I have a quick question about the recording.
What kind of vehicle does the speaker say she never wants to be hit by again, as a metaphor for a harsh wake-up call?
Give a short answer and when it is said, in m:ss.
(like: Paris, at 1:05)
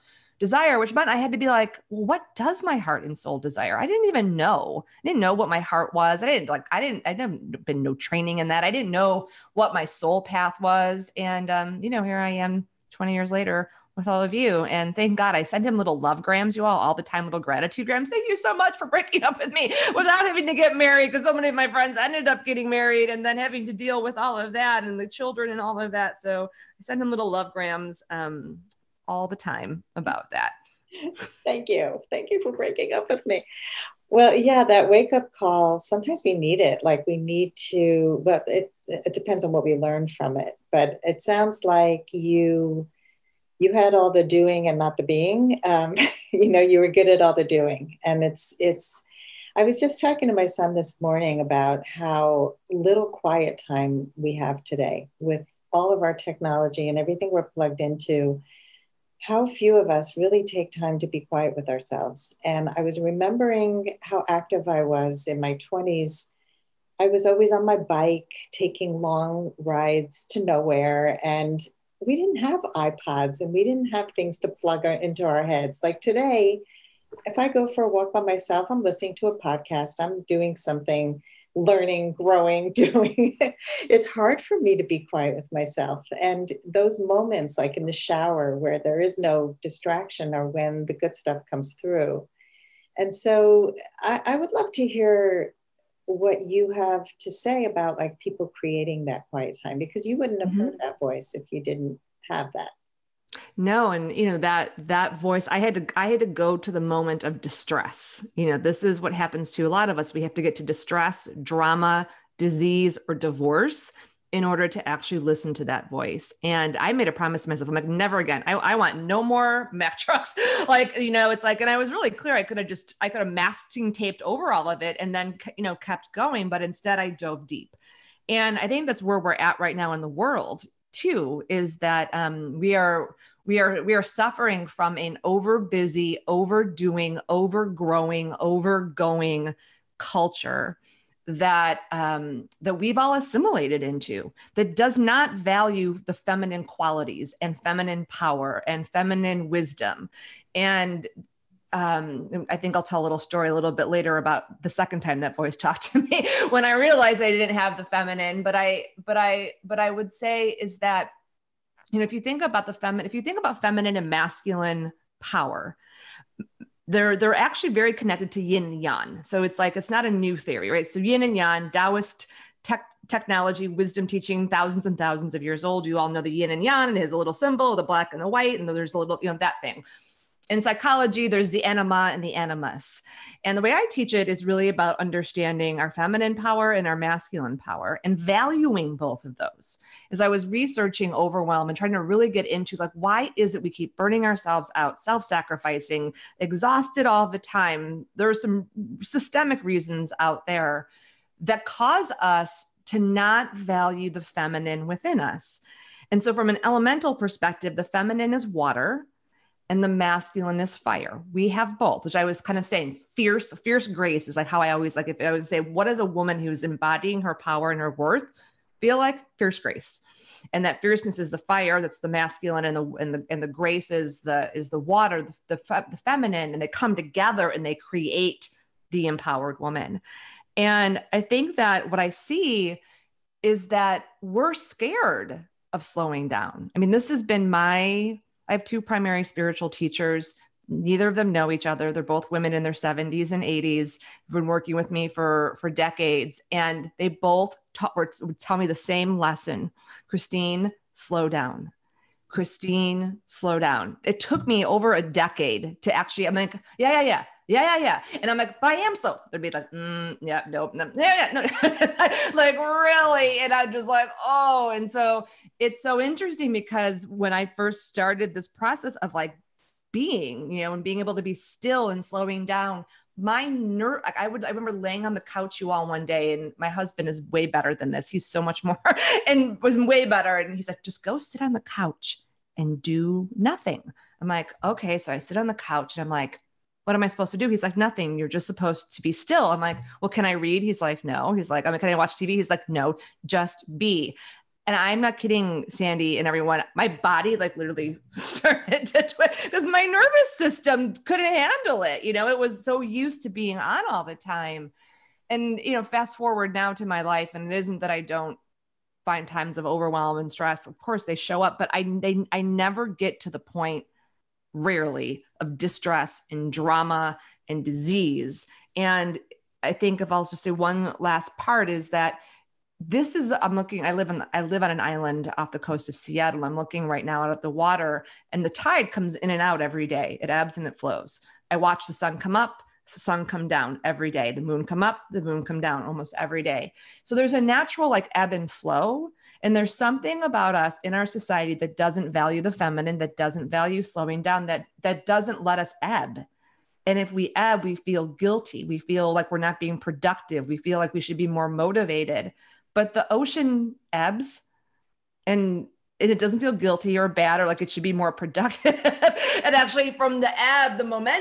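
Mack trucks, at 1:59.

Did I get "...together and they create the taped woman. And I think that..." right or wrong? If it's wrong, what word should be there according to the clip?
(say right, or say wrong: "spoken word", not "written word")
wrong: "empowered", not "taped".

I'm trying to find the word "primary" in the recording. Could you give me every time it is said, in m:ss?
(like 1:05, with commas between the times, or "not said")
3:58.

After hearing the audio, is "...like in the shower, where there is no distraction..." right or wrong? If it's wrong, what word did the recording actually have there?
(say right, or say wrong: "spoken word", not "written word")
right.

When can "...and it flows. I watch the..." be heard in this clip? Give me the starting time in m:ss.
5:30.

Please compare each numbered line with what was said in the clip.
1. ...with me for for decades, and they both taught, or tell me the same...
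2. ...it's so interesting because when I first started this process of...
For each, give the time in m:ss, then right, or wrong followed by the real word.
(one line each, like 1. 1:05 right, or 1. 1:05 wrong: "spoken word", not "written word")
1. 4:04 right
2. 4:25 right.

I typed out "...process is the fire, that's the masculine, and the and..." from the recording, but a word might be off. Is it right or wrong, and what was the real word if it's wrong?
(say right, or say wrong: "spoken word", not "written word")
wrong: "fierceness", not "process".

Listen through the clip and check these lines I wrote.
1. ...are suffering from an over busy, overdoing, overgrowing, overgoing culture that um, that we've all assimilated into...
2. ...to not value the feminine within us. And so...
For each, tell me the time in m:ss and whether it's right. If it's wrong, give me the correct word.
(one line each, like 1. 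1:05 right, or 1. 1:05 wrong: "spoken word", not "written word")
1. 2:13 right
2. 3:22 right.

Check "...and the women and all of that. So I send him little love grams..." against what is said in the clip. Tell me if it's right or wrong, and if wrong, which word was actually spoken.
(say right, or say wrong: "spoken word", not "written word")
wrong: "children", not "women".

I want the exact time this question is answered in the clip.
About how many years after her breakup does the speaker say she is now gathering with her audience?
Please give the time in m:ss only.
0:12.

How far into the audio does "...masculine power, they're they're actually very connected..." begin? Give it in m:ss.
2:44.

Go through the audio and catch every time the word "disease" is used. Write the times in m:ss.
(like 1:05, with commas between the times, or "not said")
1:52, 5:17.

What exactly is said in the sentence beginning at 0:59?
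How few of us really take time to be quiet with ourselves.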